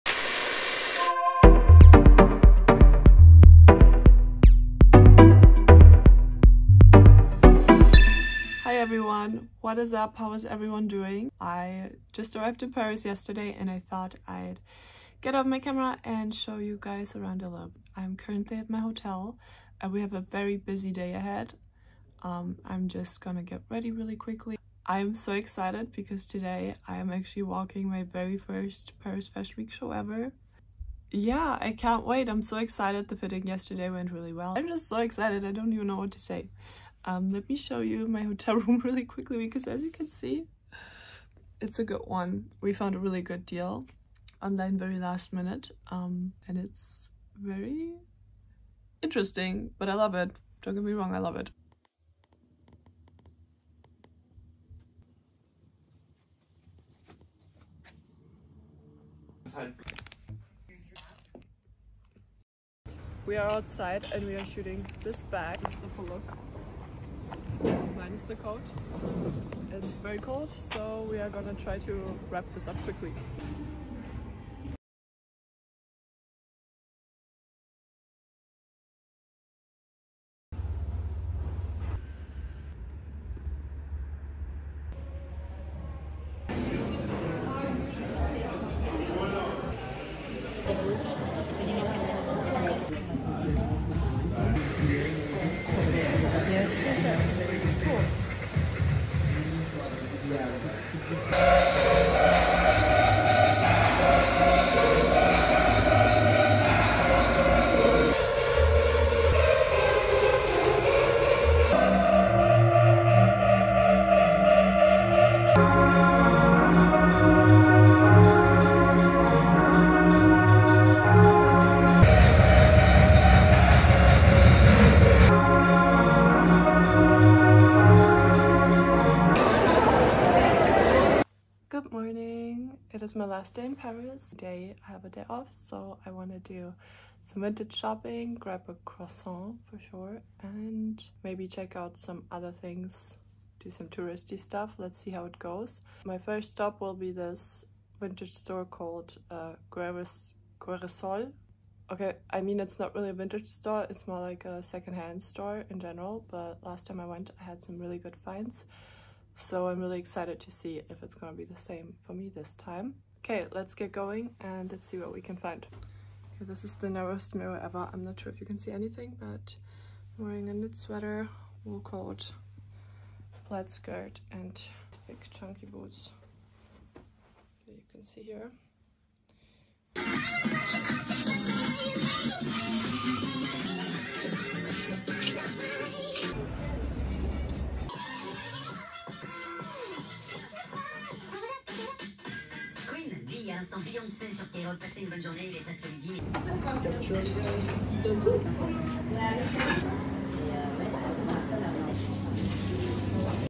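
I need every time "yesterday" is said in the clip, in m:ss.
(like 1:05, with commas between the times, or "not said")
0:13, 0:33.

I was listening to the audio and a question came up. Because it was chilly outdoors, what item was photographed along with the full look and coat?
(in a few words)
bag.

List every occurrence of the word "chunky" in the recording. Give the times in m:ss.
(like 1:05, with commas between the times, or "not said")
2:55.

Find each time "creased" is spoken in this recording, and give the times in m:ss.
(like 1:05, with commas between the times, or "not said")
not said.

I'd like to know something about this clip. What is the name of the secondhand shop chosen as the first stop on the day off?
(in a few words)
Guerres.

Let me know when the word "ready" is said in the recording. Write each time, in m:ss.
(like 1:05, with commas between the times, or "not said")
0:23.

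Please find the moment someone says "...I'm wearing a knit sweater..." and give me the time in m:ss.
2:50.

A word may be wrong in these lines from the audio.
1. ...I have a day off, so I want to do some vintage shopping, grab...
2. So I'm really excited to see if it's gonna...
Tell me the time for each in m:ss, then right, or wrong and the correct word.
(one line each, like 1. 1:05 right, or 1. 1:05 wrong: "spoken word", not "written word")
1. 2:14 right
2. 2:39 right.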